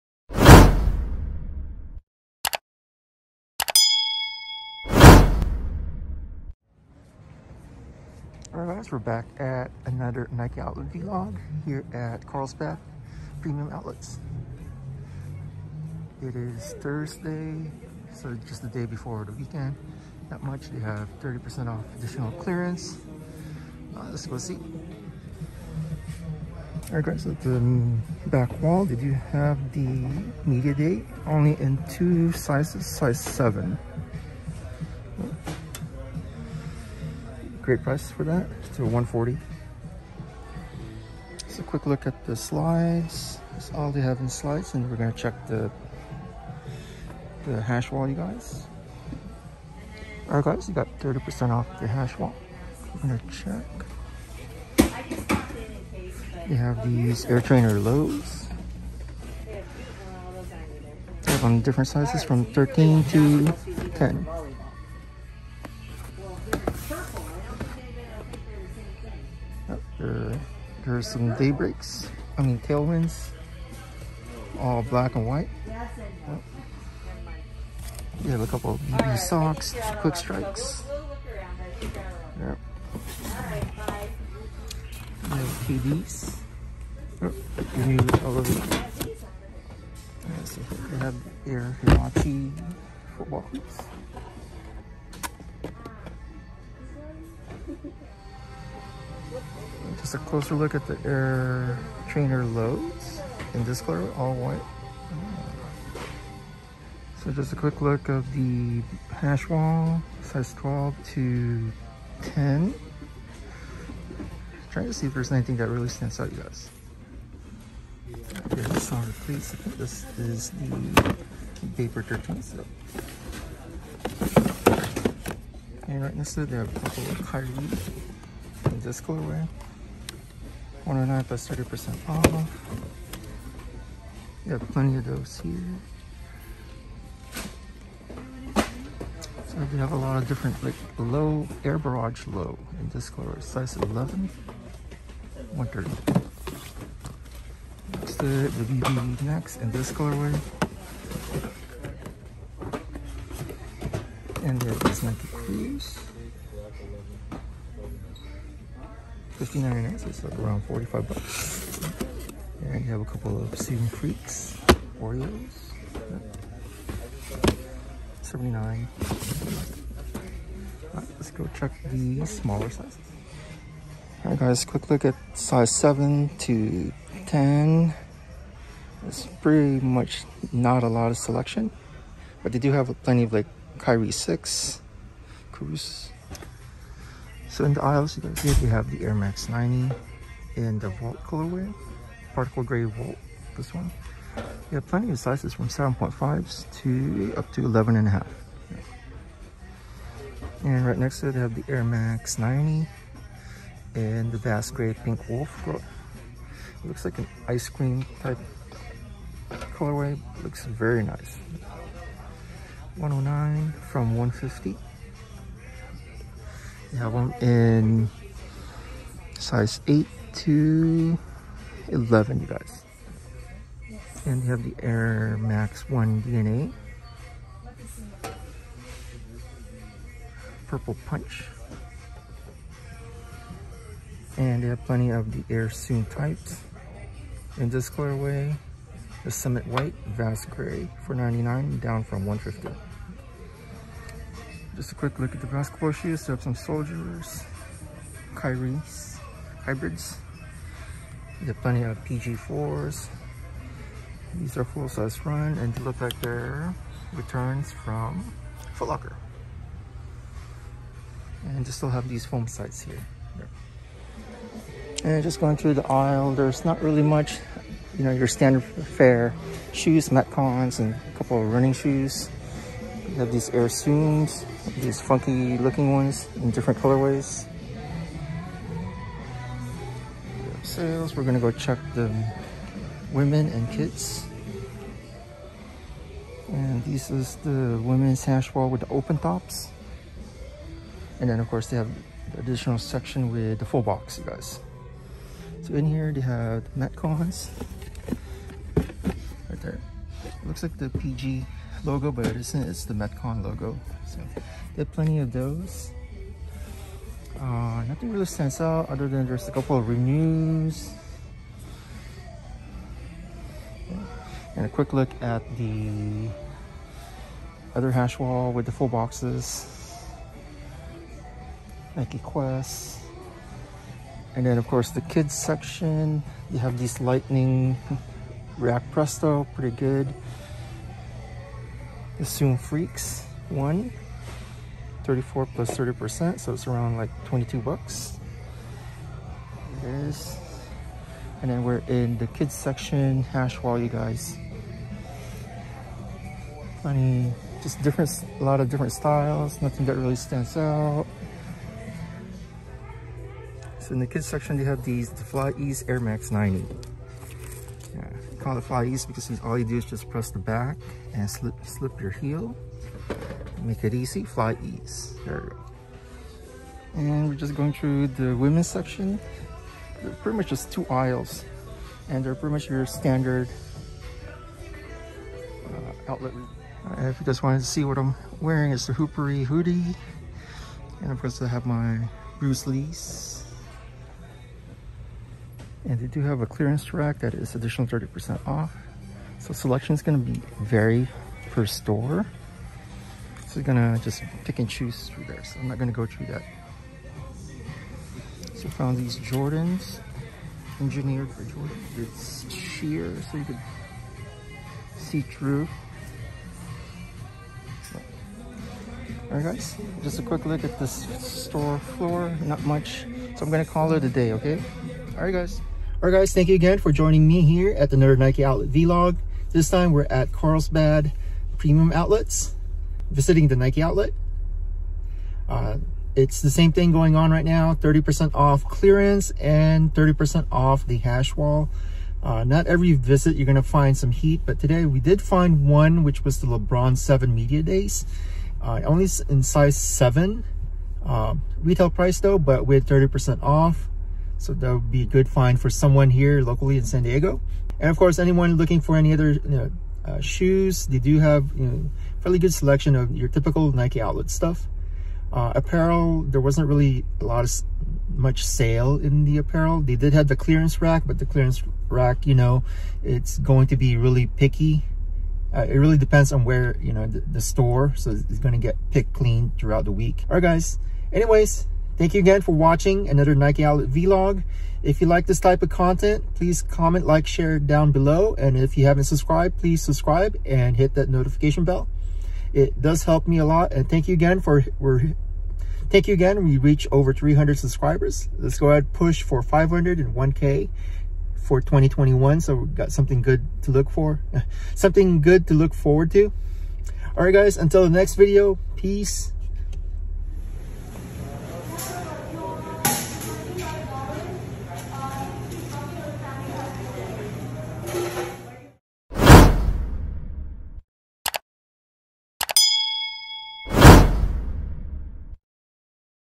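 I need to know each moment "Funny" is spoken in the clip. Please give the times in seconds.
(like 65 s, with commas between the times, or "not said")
346 s.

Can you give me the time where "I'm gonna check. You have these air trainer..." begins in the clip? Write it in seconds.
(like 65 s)
52 s.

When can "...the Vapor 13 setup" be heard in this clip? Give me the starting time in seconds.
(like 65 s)
120 s.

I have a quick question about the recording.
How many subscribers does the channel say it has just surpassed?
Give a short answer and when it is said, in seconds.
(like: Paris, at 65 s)
300, at 487 s.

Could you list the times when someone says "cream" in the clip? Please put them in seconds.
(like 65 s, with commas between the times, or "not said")
207 s.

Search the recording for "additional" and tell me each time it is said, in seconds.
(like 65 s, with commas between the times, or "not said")
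21 s, 292 s, 387 s.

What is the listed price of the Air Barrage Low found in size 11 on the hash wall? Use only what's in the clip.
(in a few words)
130.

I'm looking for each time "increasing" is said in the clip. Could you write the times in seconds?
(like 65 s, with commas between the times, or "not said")
not said.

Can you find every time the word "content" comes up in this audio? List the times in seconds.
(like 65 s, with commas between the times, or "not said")
475 s.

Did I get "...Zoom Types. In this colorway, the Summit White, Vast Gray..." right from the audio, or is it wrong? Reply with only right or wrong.
right.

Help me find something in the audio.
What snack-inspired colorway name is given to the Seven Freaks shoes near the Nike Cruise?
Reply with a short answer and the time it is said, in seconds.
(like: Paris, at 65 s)
Oreos, at 165 s.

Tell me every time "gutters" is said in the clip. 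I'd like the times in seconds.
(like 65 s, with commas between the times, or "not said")
not said.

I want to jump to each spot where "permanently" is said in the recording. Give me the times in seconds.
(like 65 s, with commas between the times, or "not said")
not said.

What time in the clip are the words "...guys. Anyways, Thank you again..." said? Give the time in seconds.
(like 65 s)
470 s.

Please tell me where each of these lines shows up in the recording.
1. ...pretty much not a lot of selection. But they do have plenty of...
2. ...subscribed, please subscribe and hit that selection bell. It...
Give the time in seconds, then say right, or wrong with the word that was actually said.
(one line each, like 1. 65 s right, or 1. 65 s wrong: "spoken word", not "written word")
1. 179 s right
2. 479 s wrong: "notification", not "selection".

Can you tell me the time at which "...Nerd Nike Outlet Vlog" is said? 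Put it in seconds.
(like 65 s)
417 s.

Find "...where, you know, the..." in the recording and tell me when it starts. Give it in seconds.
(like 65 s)
466 s.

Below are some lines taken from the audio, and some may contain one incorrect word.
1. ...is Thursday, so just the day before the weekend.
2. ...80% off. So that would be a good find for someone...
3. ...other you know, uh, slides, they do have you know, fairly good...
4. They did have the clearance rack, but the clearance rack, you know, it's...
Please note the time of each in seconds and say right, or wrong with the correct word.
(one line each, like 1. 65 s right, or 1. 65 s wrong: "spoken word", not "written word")
1. 16 s right
2. 442 s wrong: "30", not "80"
3. 449 s wrong: "shoes", not "slides"
4. 459 s right.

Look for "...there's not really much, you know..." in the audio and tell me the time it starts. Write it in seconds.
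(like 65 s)
266 s.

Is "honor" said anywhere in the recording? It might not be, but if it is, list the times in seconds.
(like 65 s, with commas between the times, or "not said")
not said.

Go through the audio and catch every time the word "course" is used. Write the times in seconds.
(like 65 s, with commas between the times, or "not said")
291 s, 324 s, 381 s, 447 s.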